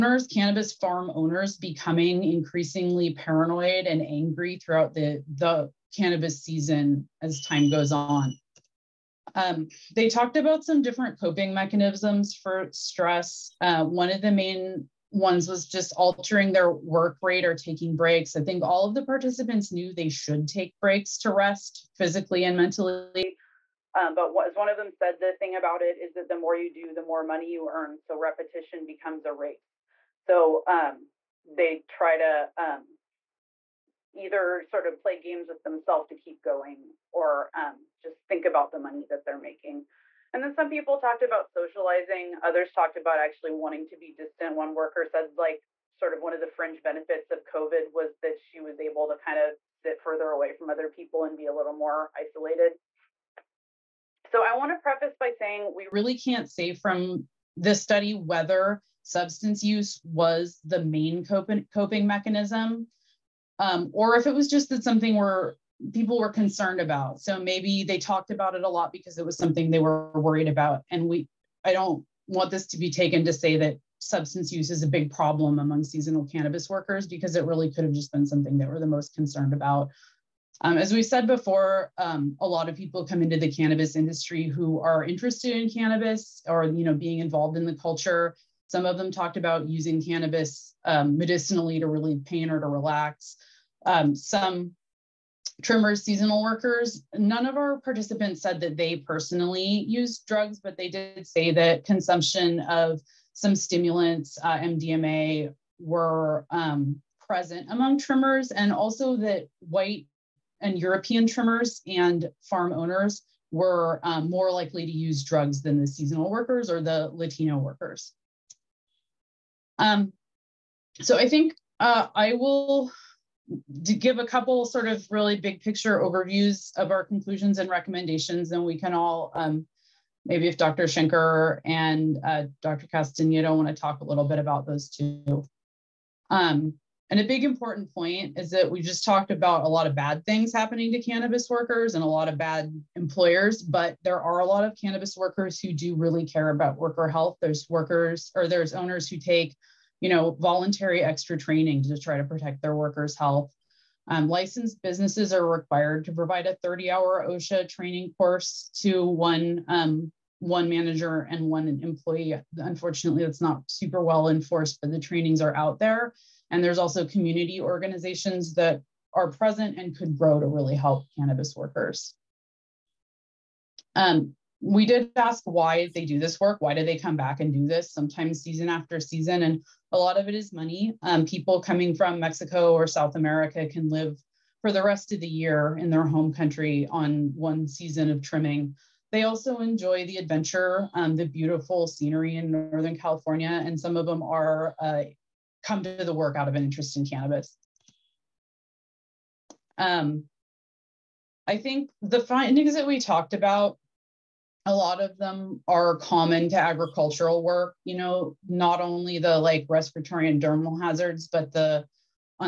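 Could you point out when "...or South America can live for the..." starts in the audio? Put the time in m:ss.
3:02.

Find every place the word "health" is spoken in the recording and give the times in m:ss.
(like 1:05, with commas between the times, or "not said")
2:27, 2:33.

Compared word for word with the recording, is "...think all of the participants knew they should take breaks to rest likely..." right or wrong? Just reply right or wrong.
wrong.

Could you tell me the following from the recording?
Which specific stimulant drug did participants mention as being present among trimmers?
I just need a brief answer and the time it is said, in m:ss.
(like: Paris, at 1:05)
MDMA, at 1:44.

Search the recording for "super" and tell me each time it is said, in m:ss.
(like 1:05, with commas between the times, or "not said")
2:43.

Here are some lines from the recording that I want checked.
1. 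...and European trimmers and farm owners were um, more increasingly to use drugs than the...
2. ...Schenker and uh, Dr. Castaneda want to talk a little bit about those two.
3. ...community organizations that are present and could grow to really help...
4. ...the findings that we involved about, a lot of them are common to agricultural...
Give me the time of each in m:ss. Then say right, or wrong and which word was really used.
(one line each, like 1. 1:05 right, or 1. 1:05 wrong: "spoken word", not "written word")
1. 1:50 wrong: "likely", not "increasingly"
2. 2:10 right
3. 2:47 right
4. 3:22 wrong: "talked", not "involved".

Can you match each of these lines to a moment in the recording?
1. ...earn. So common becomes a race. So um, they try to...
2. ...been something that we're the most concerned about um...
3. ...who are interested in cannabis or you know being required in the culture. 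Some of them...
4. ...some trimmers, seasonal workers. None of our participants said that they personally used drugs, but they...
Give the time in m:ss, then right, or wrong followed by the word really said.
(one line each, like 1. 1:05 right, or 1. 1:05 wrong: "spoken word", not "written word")
1. 0:27 wrong: "repetition", not "common"
2. 1:18 right
3. 1:24 wrong: "involved", not "required"
4. 1:34 right.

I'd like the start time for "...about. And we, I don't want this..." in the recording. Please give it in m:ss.
1:10.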